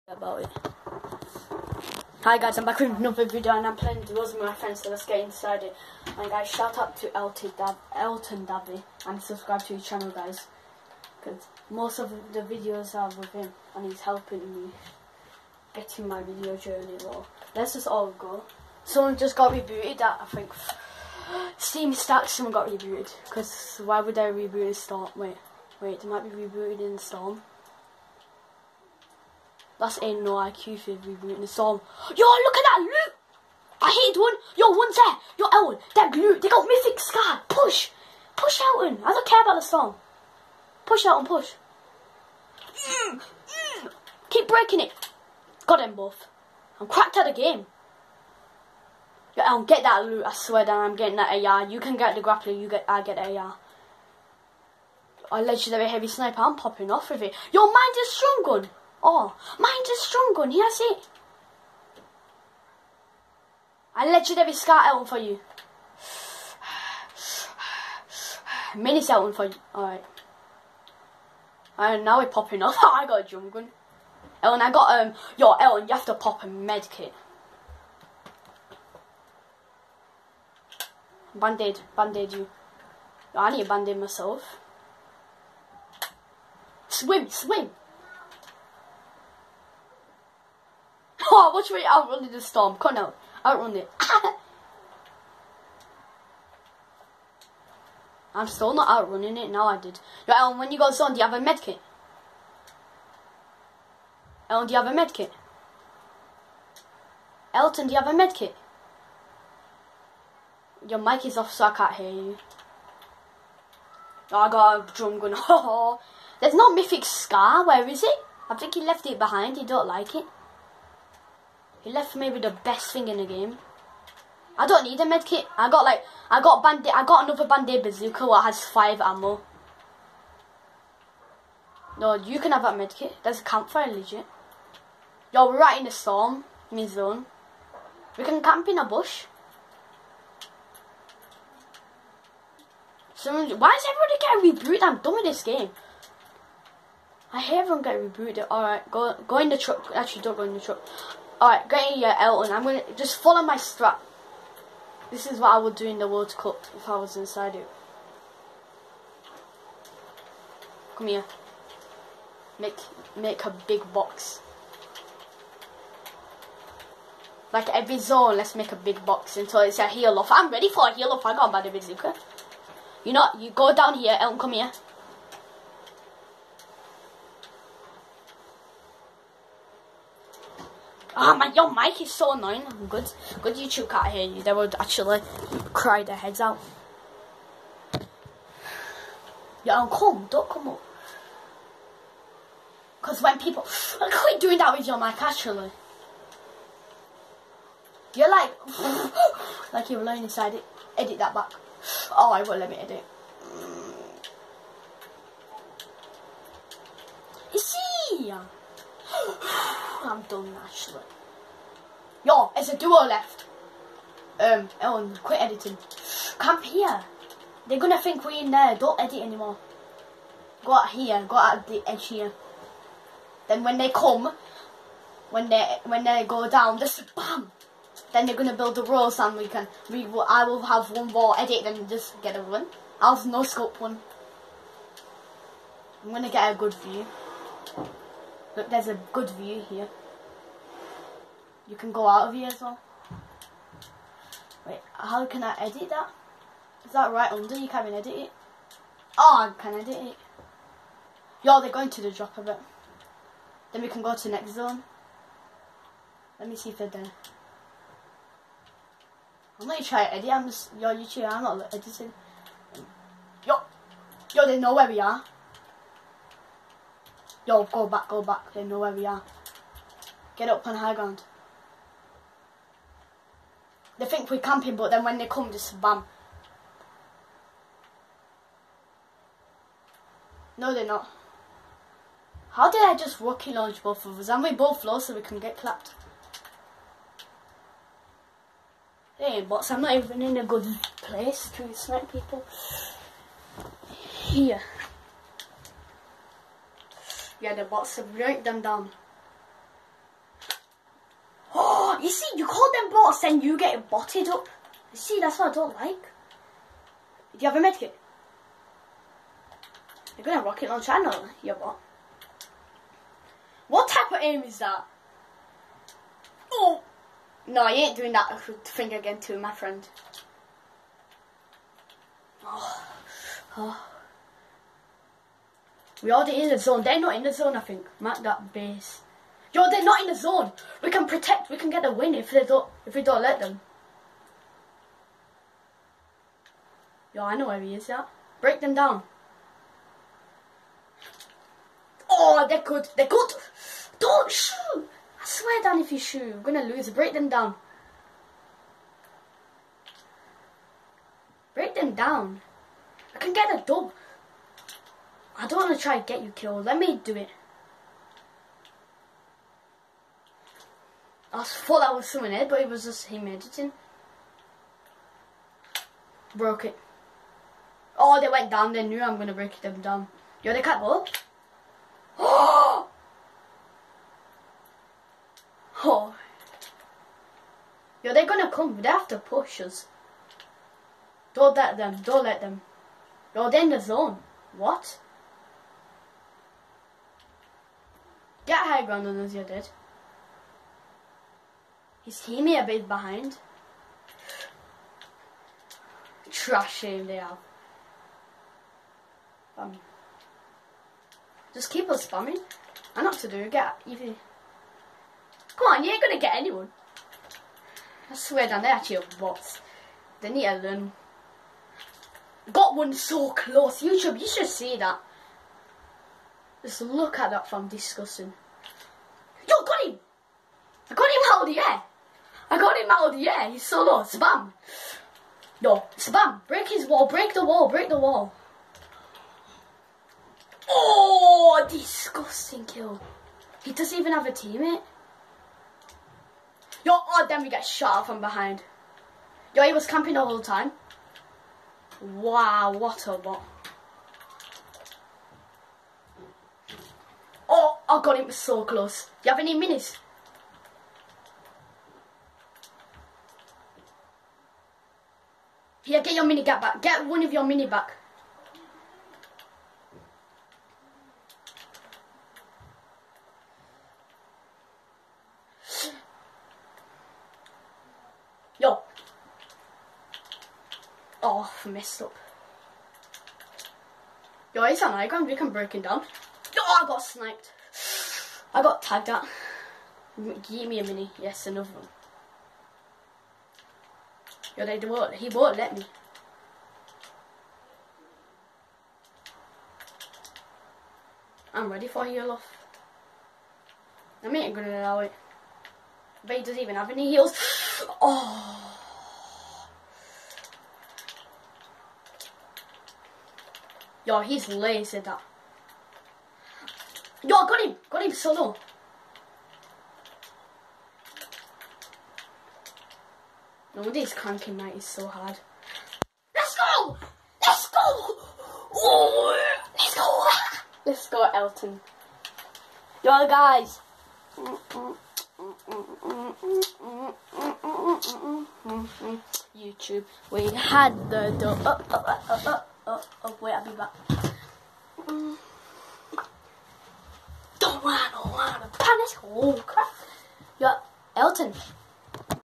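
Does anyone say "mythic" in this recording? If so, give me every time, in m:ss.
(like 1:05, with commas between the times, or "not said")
0:36, 1:56.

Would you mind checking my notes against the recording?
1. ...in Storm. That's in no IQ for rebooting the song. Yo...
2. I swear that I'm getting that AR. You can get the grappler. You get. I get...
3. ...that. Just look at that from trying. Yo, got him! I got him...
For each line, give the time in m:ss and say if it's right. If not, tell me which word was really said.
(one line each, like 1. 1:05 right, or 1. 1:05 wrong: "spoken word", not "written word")
1. 0:26 right
2. 0:50 right
3. 6:54 wrong: "disgusting", not "trying".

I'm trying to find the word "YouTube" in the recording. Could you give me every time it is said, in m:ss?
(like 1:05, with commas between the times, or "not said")
3:03, 4:20, 6:53, 8:49.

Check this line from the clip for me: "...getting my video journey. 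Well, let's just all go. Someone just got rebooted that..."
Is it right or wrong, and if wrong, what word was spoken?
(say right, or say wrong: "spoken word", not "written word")
right.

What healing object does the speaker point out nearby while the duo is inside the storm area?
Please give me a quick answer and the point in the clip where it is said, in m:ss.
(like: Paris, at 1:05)
Campfire, at 2:13.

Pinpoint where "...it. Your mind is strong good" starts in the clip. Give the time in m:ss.
0:57.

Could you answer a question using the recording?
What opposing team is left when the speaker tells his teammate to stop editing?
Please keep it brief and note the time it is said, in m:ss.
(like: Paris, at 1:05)
A duo, at 3:32.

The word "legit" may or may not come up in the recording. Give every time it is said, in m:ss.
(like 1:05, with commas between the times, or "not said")
2:13.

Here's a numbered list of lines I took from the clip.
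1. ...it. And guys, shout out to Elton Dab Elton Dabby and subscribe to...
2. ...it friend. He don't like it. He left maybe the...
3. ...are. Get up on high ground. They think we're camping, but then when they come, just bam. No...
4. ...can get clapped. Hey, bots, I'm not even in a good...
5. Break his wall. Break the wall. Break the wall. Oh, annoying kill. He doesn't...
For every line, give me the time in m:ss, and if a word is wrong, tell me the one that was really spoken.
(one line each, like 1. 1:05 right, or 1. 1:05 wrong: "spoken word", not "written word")
1. 0:05 right
2. 1:59 wrong: "behind", not "friend"
3. 4:29 right
4. 4:45 right
5. 7:06 wrong: "disgusting", not "annoying".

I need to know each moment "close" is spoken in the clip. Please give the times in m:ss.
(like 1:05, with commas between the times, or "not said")
6:53, 7:28.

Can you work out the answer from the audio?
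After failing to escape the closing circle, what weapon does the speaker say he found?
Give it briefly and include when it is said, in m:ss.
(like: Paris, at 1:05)
Drum gun, at 1:54.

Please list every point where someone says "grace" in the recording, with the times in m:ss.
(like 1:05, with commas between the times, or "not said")
not said.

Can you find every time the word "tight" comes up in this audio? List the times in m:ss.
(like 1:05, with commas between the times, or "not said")
not said.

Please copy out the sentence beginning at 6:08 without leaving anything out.
They knew I'm gonna break them down.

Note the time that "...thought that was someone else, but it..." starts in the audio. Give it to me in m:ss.
6:01.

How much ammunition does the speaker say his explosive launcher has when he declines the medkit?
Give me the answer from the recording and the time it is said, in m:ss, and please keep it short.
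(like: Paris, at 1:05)
5, at 2:08.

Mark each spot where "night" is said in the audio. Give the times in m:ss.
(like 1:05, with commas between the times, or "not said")
8:34.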